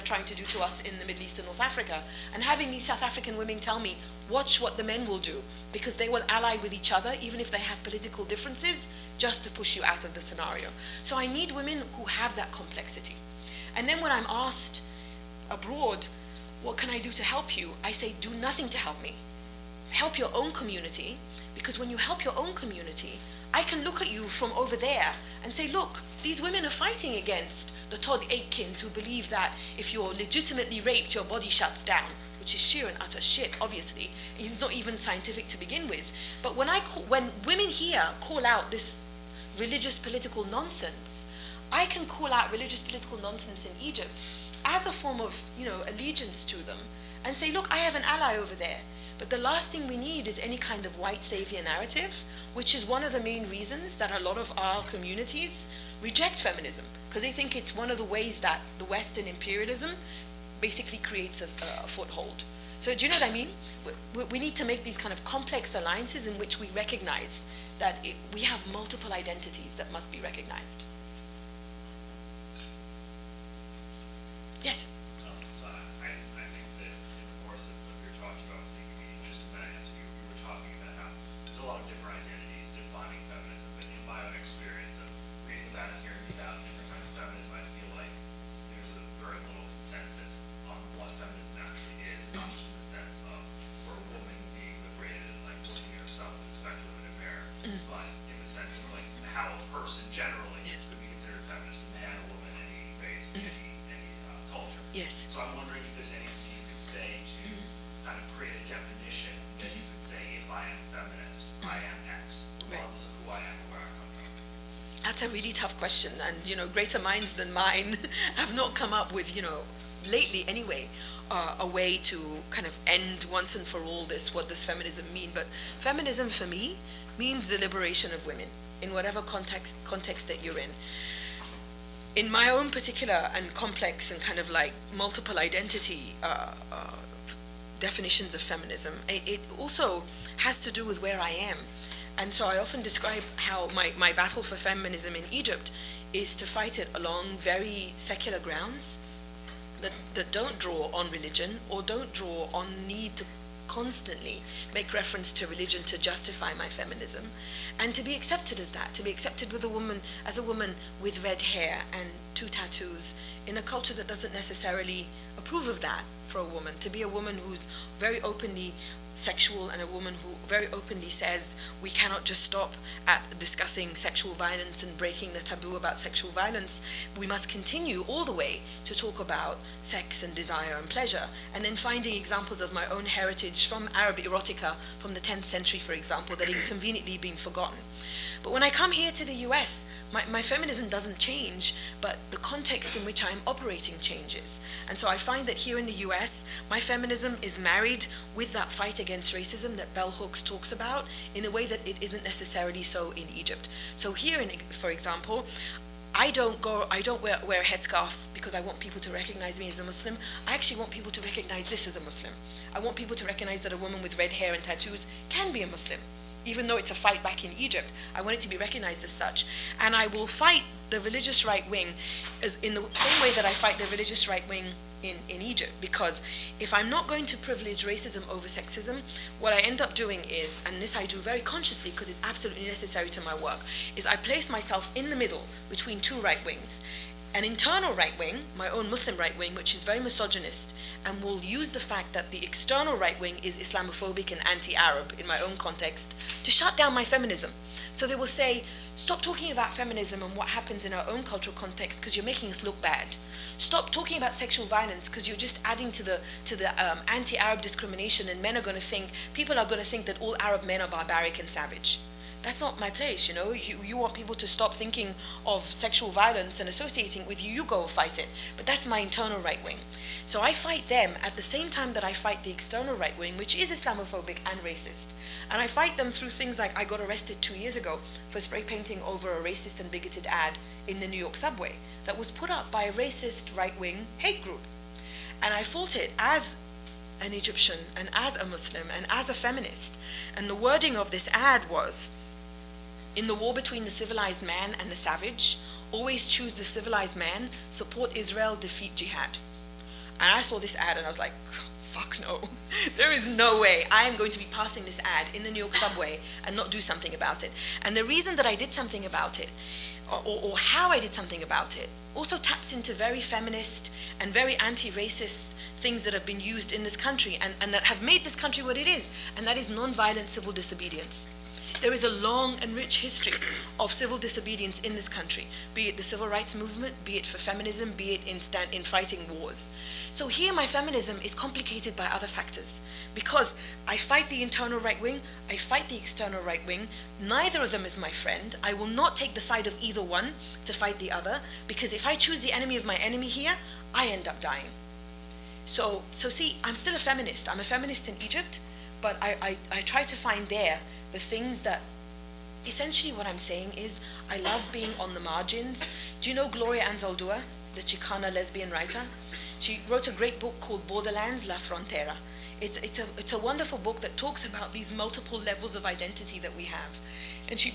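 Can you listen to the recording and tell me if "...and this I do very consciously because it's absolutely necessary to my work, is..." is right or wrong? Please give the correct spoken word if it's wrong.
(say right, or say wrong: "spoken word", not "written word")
right.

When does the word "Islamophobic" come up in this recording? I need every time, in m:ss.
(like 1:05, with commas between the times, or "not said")
4:03, 4:33.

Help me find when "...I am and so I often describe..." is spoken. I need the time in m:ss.
2:21.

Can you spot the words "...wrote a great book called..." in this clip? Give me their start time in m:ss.
5:59.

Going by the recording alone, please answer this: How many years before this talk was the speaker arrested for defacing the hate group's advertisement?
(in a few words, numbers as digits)
2.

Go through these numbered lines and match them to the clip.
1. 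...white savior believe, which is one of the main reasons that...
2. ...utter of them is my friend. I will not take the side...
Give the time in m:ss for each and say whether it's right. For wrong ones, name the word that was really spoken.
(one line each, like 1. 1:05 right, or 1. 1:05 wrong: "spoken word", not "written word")
1. 0:50 wrong: "narrative", not "believe"
2. 5:37 wrong: "neither", not "utter".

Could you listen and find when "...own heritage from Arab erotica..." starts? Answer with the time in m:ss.
3:02.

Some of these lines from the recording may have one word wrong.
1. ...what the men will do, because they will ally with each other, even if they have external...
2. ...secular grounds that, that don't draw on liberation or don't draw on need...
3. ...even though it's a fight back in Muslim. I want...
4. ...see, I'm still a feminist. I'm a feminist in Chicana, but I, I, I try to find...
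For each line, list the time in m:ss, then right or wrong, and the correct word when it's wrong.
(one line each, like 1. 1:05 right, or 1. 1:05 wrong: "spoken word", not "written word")
1. 0:04 wrong: "political", not "external"
2. 2:27 wrong: "religion", not "liberation"
3. 3:36 wrong: "Egypt", not "Muslim"
4. 5:46 wrong: "Egypt", not "Chicana".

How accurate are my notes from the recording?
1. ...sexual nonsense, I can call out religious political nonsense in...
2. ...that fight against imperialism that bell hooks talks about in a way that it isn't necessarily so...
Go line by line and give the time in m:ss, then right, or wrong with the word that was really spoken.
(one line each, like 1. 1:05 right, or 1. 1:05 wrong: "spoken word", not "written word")
1. 0:39 wrong: "political", not "sexual"
2. 3:18 wrong: "racism", not "imperialism".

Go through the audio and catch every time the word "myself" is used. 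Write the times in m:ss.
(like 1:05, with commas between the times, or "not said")
3:54.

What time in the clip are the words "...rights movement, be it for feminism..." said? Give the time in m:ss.
5:26.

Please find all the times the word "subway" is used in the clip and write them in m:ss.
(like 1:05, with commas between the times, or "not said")
4:41, 5:05.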